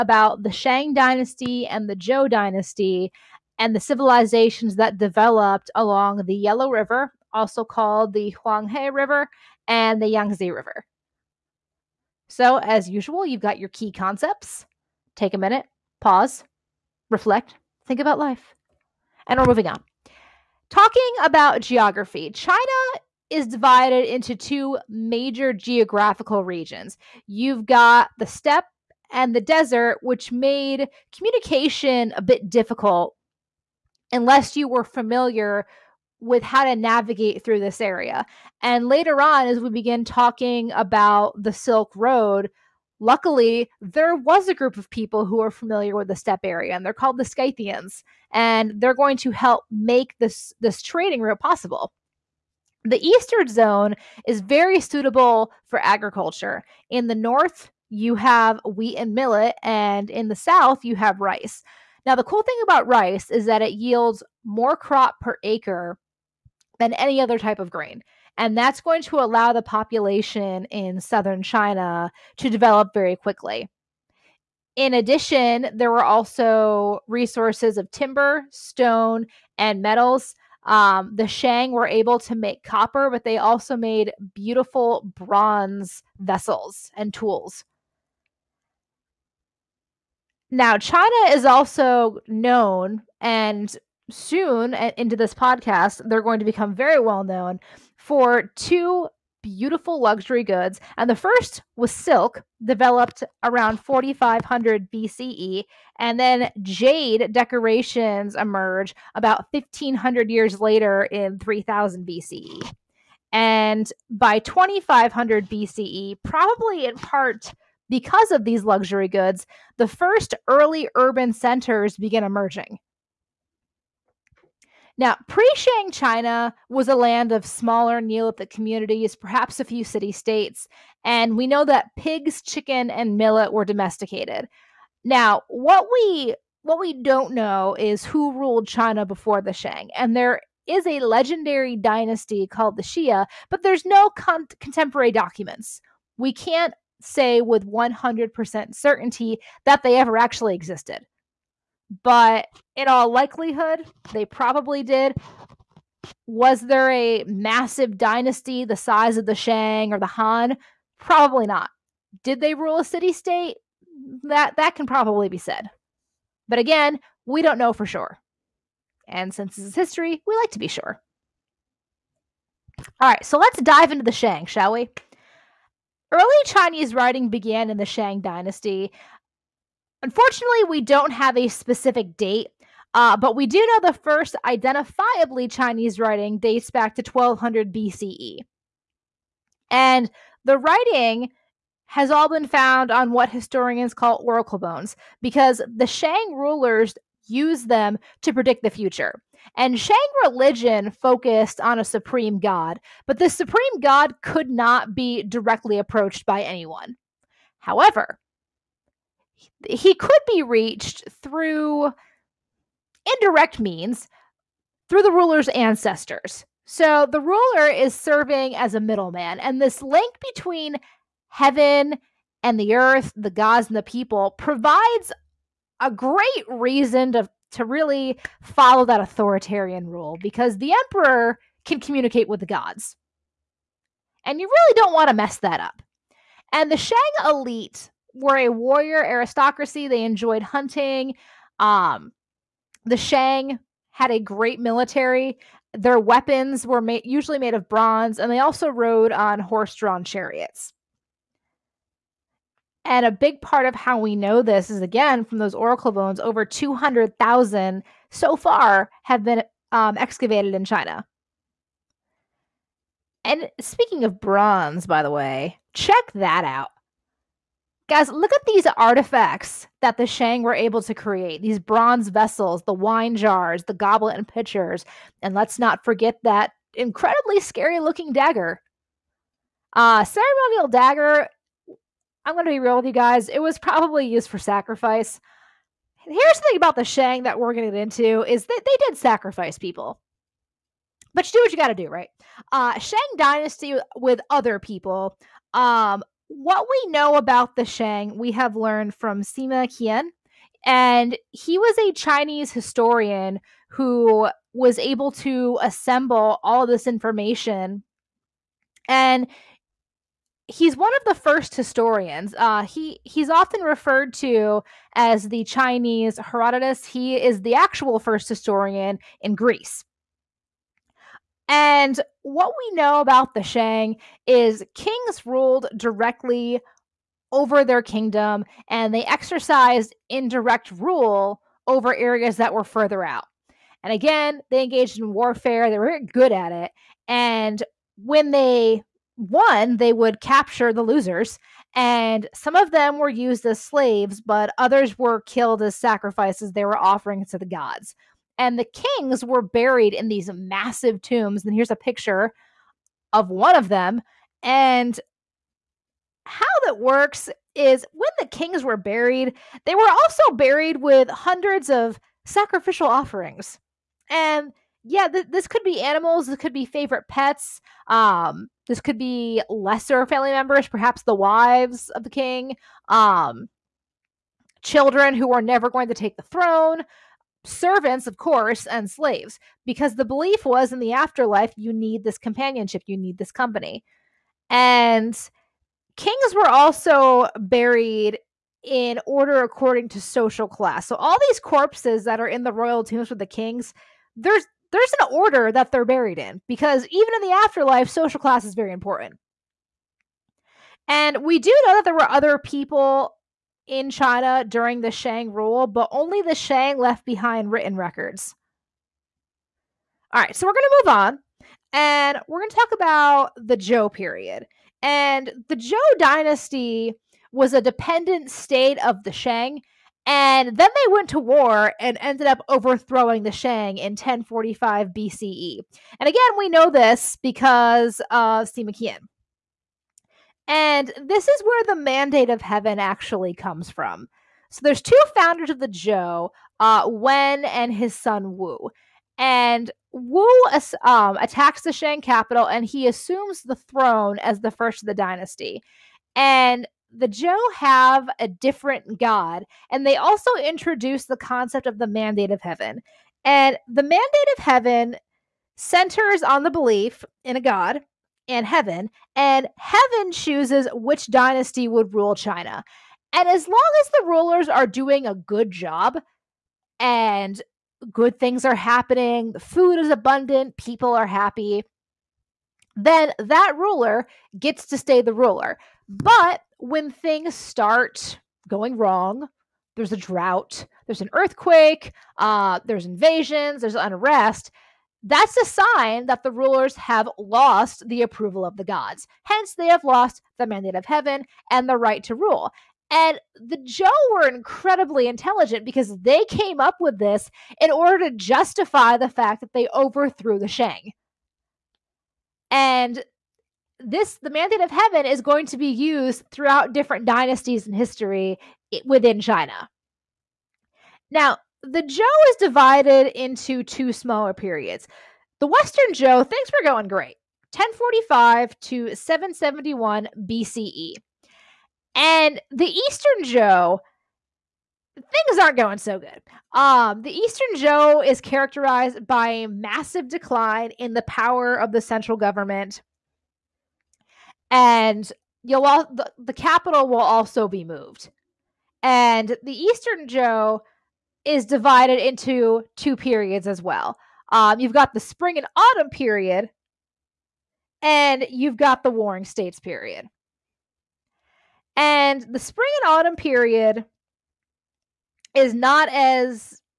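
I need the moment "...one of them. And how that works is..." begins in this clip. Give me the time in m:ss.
5:53.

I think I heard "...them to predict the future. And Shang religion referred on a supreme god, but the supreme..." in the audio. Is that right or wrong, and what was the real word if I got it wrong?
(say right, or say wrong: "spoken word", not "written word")
wrong: "focused", not "referred".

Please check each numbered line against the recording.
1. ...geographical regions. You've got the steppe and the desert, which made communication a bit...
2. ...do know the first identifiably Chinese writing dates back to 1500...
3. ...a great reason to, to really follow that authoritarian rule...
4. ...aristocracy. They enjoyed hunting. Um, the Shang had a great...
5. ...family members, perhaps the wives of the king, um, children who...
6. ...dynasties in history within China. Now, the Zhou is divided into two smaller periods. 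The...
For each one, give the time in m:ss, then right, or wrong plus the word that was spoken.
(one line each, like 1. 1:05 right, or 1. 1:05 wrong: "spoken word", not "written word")
1. 0:25 right
2. 3:03 wrong: "1200", not "1500"
3. 3:45 right
4. 3:59 right
5. 6:10 right
6. 8:27 right.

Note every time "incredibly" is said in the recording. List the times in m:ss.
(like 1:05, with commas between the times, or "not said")
4:36, 8:14.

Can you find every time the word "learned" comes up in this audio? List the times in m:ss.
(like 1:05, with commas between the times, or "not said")
4:58.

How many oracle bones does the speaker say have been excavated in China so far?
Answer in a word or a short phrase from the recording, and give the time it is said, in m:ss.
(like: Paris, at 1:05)
over 200,000, at 4:16.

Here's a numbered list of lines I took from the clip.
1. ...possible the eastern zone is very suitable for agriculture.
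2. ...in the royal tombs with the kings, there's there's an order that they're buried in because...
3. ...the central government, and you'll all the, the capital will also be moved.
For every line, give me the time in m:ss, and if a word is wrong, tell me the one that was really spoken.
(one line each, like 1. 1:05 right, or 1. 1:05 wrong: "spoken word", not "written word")
1. 0:51 right
2. 6:32 right
3. 8:51 right.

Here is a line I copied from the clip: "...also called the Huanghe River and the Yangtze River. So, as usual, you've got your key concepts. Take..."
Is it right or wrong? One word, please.
right.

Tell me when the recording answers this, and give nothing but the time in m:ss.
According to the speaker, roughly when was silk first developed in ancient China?
1:43.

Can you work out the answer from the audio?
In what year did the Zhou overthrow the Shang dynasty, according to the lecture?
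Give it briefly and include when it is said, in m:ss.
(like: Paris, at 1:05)
1045 BCE, at 7:03.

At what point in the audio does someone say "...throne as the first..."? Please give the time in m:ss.
7:23.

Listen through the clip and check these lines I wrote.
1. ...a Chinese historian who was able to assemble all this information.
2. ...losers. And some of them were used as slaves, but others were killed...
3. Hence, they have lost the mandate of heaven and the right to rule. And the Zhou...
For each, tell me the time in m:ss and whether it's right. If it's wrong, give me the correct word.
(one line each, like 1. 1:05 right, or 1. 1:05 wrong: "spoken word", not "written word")
1. 5:01 right
2. 5:40 right
3. 8:09 right.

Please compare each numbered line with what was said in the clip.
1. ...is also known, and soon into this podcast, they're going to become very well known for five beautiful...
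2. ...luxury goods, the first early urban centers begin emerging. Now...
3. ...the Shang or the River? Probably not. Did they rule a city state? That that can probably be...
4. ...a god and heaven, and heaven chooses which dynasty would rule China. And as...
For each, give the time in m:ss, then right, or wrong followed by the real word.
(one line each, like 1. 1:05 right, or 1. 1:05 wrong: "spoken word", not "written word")
1. 1:31 wrong: "two", not "five"
2. 1:58 right
3. 2:39 wrong: "Han", not "River"
4. 7:37 right.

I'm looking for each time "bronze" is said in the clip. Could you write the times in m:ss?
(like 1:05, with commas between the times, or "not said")
1:25, 4:07, 4:24, 4:31.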